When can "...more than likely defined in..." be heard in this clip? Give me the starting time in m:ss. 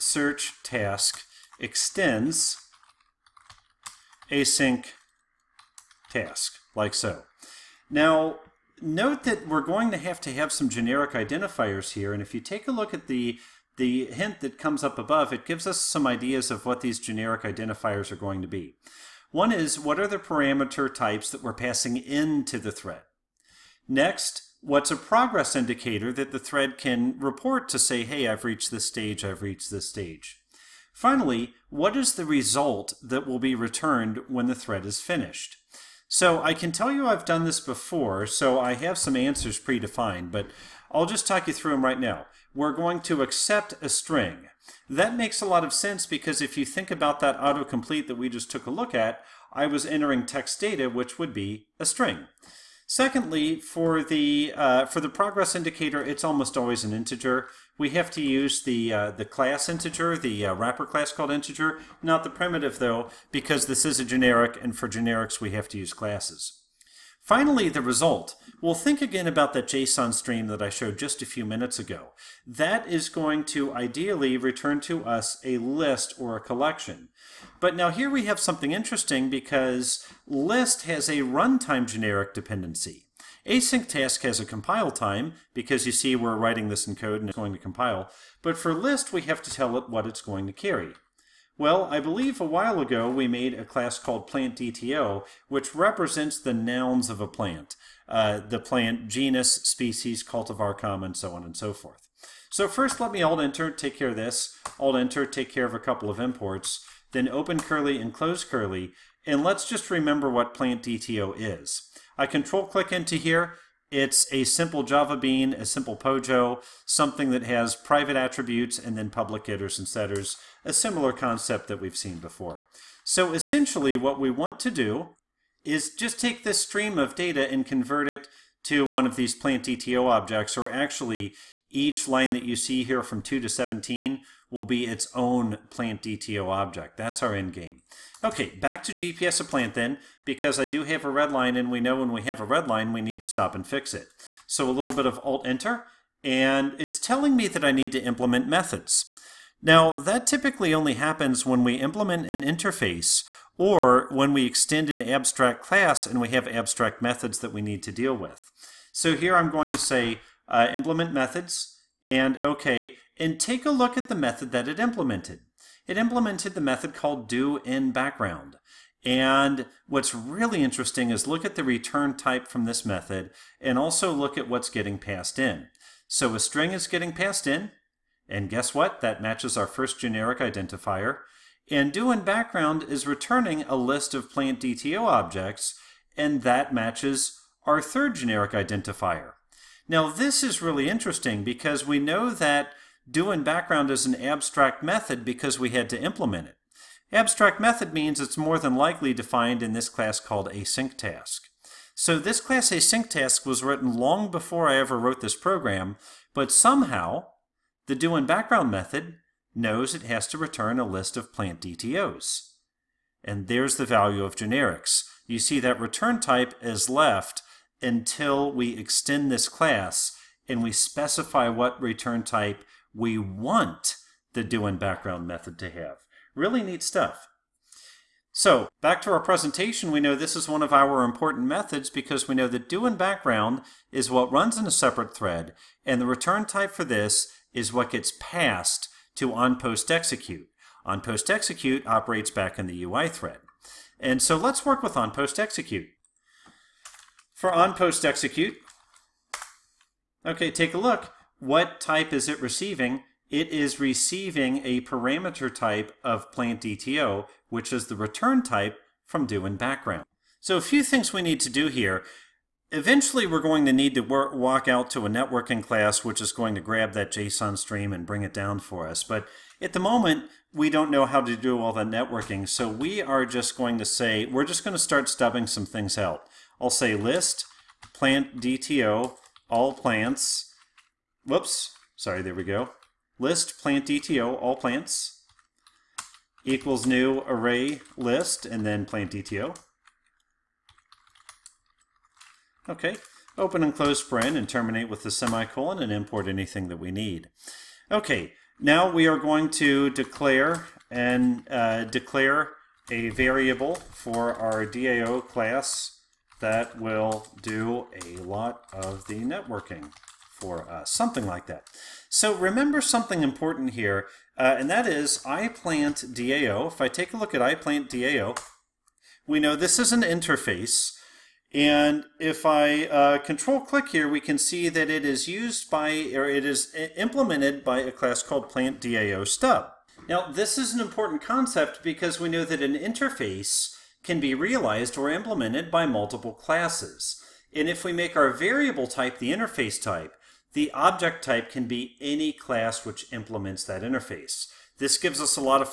3:18.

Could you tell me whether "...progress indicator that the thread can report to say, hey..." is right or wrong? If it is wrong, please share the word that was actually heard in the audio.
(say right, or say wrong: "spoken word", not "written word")
right.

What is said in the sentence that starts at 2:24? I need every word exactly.
So a little bit of Alt-Enter, and it's telling me that I need to implement methods.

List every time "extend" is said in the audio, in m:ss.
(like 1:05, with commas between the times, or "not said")
0:01, 2:34, 3:38.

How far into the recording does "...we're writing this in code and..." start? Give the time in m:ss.
1:26.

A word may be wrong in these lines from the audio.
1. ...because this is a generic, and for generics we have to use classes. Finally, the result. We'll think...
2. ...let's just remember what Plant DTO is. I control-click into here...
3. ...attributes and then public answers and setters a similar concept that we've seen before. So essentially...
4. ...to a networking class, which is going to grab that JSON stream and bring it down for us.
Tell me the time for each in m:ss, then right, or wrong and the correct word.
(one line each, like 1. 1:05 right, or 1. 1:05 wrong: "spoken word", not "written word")
1. 1:03 right
2. 1:49 right
3. 1:58 wrong: "getters", not "answers"
4. 4:24 right.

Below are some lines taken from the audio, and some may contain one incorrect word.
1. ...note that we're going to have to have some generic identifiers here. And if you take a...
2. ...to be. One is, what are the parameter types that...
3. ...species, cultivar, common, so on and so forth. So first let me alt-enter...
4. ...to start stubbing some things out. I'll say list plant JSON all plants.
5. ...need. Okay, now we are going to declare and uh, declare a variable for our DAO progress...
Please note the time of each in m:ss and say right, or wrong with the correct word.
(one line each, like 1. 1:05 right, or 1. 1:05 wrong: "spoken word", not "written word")
1. 0:08 right
2. 0:18 right
3. 1:39 right
4. 4:34 wrong: "DTO", not "JSON"
5. 4:56 wrong: "class", not "progress".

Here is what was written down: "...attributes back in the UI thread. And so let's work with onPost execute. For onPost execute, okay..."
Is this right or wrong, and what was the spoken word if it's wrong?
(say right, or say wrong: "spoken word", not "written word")
wrong: "operates", not "attributes".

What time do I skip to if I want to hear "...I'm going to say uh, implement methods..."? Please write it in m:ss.
2:39.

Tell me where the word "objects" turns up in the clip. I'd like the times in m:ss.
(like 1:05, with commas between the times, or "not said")
2:10, 2:16, 3:05, 5:40.